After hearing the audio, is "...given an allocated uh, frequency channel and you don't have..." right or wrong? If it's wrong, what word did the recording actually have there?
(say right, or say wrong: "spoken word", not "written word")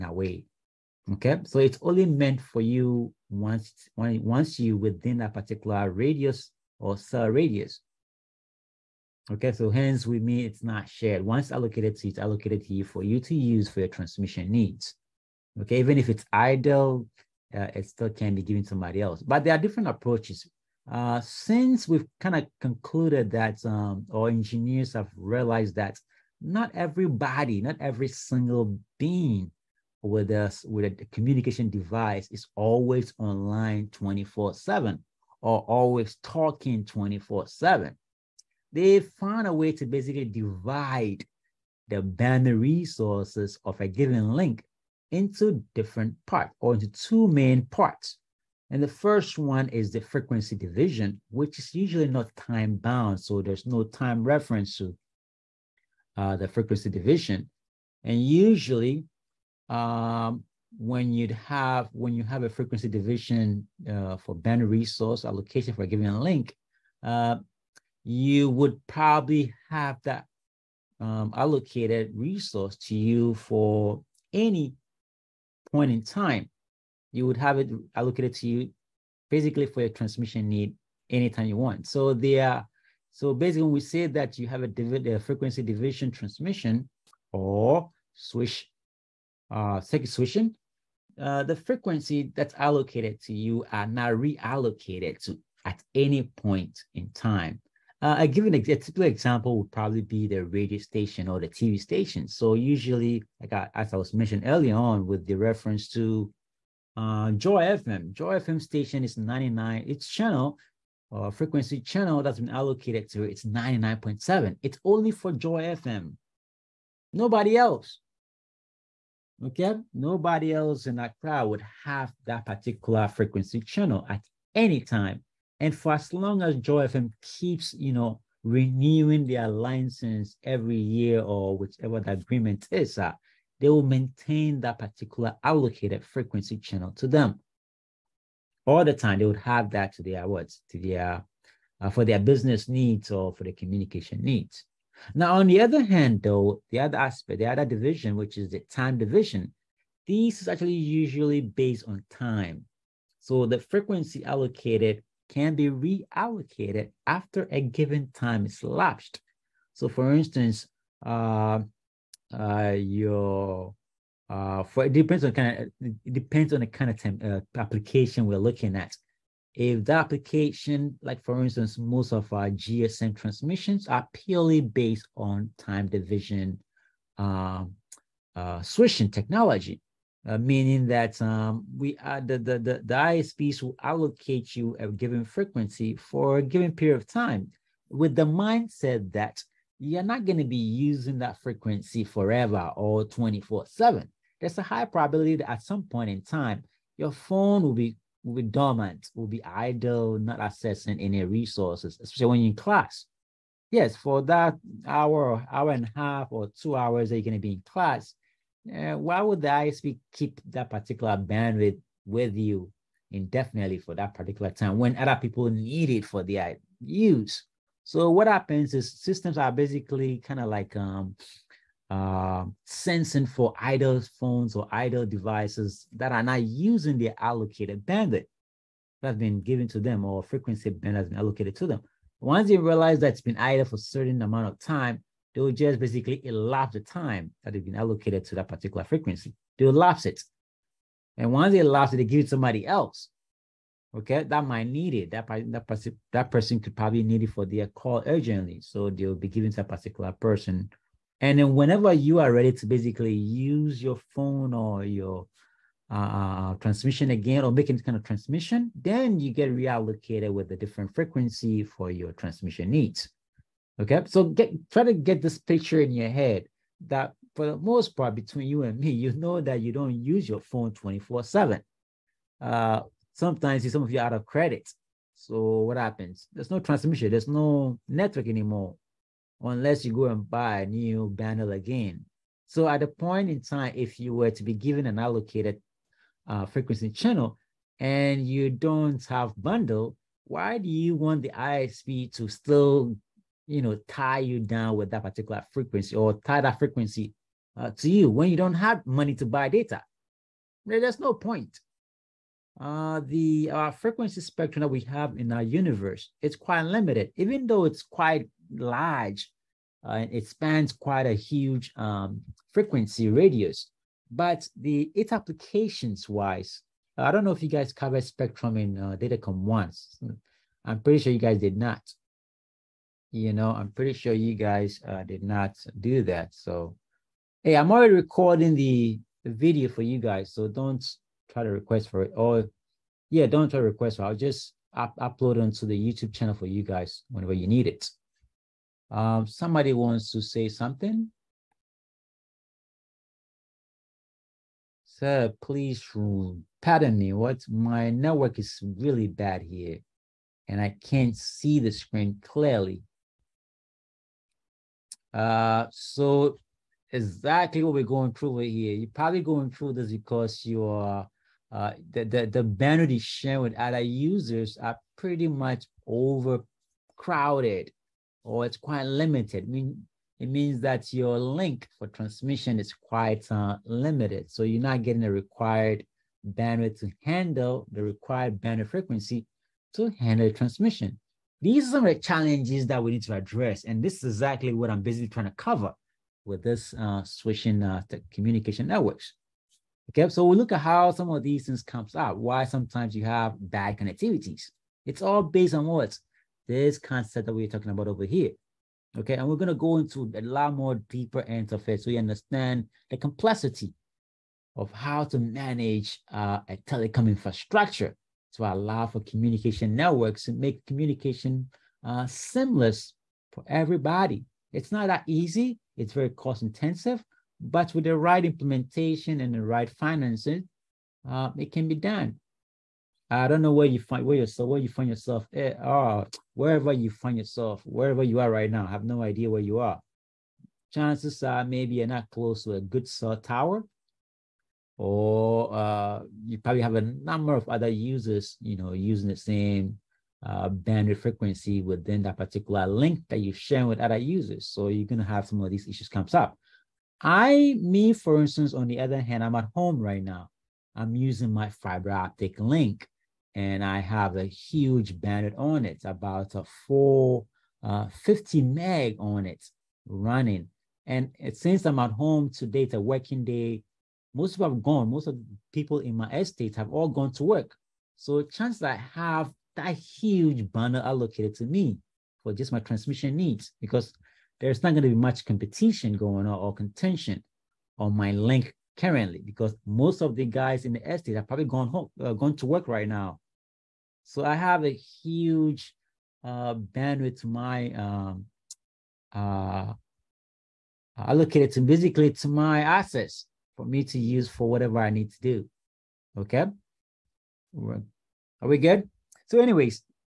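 right.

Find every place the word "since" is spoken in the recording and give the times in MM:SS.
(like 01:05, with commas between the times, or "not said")
00:21, 07:41.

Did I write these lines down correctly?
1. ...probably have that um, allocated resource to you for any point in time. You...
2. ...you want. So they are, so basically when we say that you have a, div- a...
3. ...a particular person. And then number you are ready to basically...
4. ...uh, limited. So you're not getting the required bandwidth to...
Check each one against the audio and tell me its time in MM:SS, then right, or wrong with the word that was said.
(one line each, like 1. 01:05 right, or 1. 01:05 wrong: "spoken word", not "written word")
1. 01:08 right
2. 01:21 right
3. 04:09 wrong: "whenever", not "number"
4. 06:13 right.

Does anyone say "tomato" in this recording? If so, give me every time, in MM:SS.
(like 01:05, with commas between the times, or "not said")
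not said.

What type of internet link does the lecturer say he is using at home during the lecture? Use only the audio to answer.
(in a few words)
Fiber optic.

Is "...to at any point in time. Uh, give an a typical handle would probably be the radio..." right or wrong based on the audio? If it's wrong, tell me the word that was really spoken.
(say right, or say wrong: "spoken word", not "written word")
wrong: "example", not "handle".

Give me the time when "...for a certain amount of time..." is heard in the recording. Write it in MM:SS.
03:53.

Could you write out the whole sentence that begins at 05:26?
So, hey, I'm already recording the, the video for you guys.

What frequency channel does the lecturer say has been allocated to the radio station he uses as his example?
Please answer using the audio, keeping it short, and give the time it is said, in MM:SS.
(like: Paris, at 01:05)
99.7, at 01:53.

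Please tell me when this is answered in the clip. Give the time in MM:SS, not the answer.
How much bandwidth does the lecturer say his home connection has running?
07:38.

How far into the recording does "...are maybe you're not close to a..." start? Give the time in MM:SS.
07:11.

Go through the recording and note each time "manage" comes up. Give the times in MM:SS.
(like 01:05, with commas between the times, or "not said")
06:45.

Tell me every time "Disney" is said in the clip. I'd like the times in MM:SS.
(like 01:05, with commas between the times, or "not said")
not said.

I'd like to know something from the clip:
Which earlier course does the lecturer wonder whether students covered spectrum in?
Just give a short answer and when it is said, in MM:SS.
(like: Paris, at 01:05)
Datacom, at 05:18.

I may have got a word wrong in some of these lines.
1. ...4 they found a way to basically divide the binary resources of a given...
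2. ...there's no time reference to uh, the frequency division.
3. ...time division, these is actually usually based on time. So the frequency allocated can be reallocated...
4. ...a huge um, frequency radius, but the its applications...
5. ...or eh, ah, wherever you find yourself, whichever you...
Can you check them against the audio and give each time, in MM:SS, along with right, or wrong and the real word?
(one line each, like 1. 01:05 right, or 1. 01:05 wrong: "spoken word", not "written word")
1. 00:37 wrong: "7", not "4"
2. 00:53 right
3. 02:28 right
4. 05:11 right
5. 07:05 wrong: "wherever", not "whichever".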